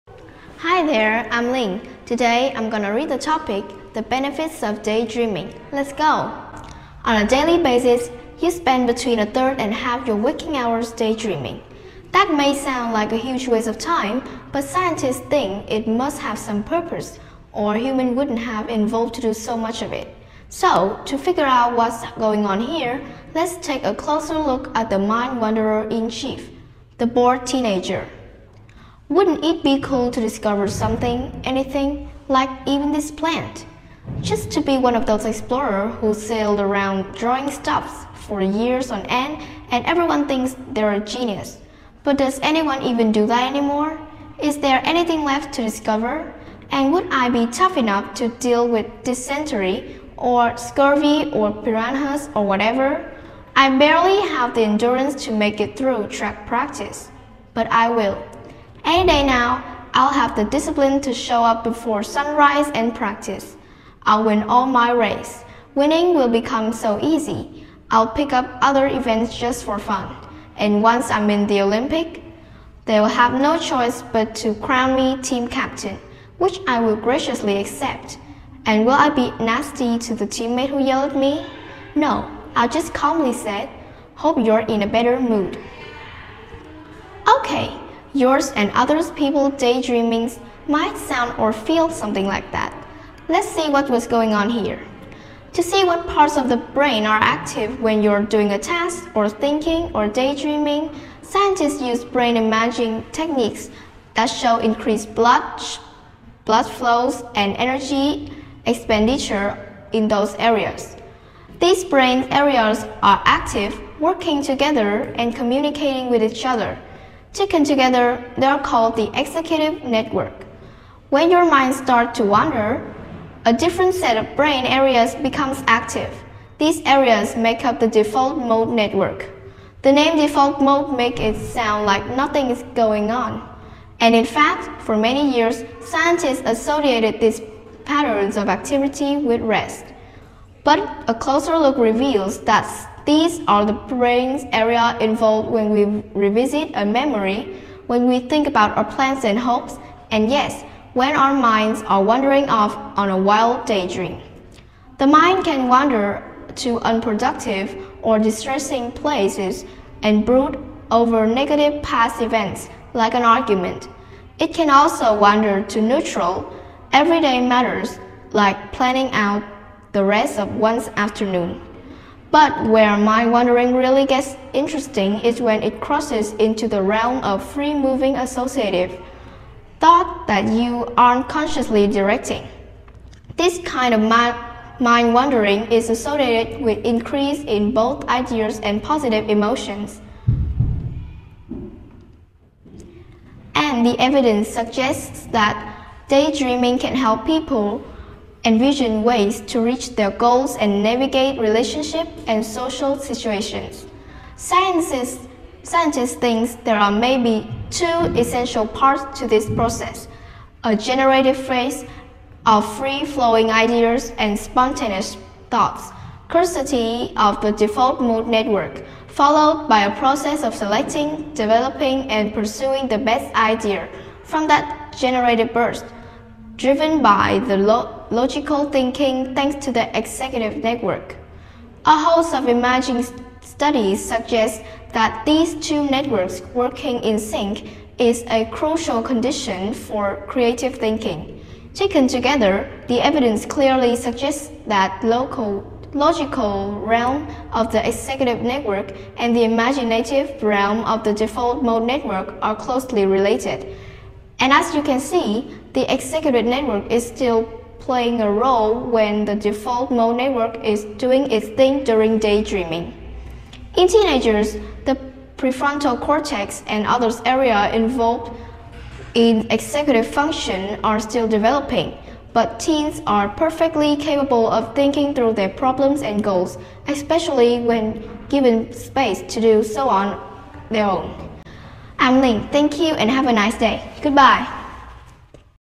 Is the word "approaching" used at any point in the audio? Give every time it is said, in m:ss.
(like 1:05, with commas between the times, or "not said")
not said.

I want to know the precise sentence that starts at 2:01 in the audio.
When your mind starts to wander, a different set of brain areas becomes active.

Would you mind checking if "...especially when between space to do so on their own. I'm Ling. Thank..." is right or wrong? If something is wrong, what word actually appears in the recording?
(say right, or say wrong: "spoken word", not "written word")
wrong: "given", not "between".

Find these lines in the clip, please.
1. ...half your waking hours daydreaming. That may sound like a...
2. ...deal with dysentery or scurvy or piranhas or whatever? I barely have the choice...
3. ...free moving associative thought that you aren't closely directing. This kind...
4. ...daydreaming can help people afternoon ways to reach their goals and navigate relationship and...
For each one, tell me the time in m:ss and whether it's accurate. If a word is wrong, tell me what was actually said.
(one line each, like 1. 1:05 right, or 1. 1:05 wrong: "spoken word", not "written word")
1. 0:09 right
2. 0:48 wrong: "endurance", not "choice"
3. 2:57 wrong: "consciously", not "closely"
4. 3:16 wrong: "envision", not "afternoon".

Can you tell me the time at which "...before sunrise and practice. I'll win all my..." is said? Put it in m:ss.
1:01.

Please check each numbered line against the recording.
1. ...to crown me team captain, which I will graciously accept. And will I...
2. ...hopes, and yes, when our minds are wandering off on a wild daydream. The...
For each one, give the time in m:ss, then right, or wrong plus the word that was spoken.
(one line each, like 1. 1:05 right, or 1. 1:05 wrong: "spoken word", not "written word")
1. 1:14 right
2. 2:29 right.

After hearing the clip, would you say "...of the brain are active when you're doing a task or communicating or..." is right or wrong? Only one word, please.
wrong.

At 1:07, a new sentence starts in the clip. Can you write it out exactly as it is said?
I'll pick up other events just for fun.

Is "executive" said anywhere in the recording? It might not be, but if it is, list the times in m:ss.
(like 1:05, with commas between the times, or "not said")
1:59, 3:49, 4:07, 4:15, 4:29.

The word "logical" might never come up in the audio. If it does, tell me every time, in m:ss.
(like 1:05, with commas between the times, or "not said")
3:48, 4:05.